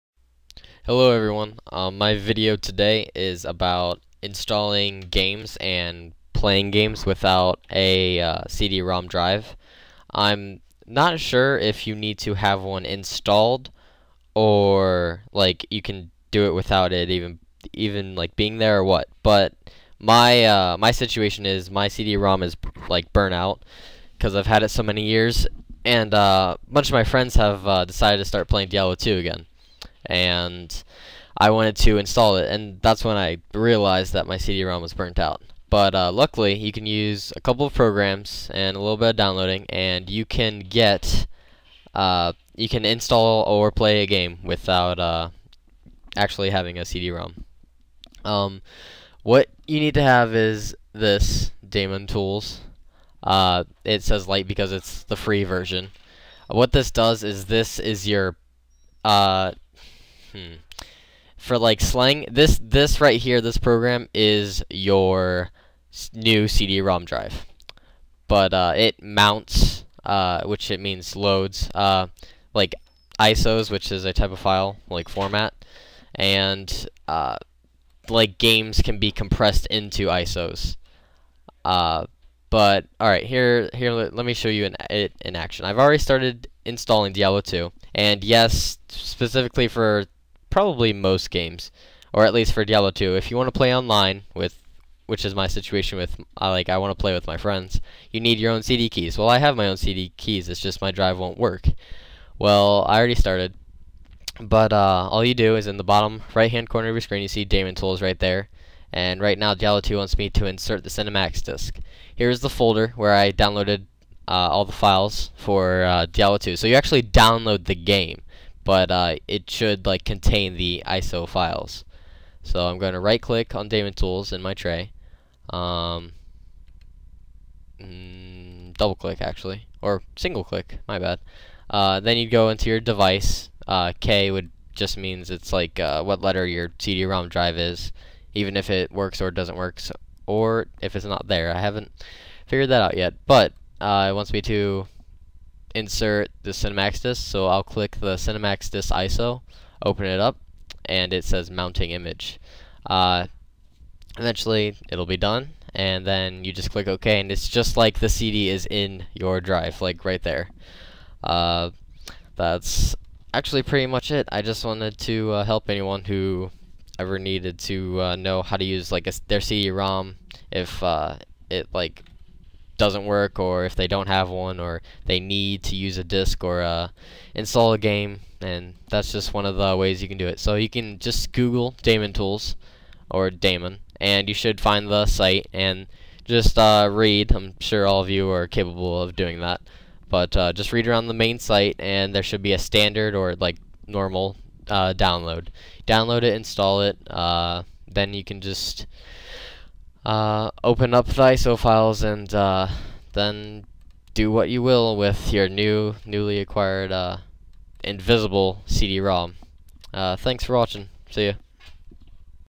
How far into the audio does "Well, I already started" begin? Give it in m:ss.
1:42.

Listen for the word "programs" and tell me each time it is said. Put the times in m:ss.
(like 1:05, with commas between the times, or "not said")
0:37, 1:03.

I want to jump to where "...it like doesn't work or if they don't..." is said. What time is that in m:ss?
2:51.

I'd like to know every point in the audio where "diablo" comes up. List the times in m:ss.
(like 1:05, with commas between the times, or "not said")
0:28, 1:27, 1:32, 1:49, 1:56.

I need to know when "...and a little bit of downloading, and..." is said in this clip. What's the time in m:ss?
0:38.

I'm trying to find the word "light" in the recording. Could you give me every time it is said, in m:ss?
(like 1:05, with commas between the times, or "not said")
0:54.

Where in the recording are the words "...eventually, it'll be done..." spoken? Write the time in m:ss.
2:34.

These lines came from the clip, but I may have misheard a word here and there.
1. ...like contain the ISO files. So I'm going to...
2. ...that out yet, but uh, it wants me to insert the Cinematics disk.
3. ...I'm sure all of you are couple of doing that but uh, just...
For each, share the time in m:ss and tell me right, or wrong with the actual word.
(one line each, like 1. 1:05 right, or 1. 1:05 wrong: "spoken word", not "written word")
1. 1:59 right
2. 2:22 right
3. 3:07 wrong: "capable", not "couple".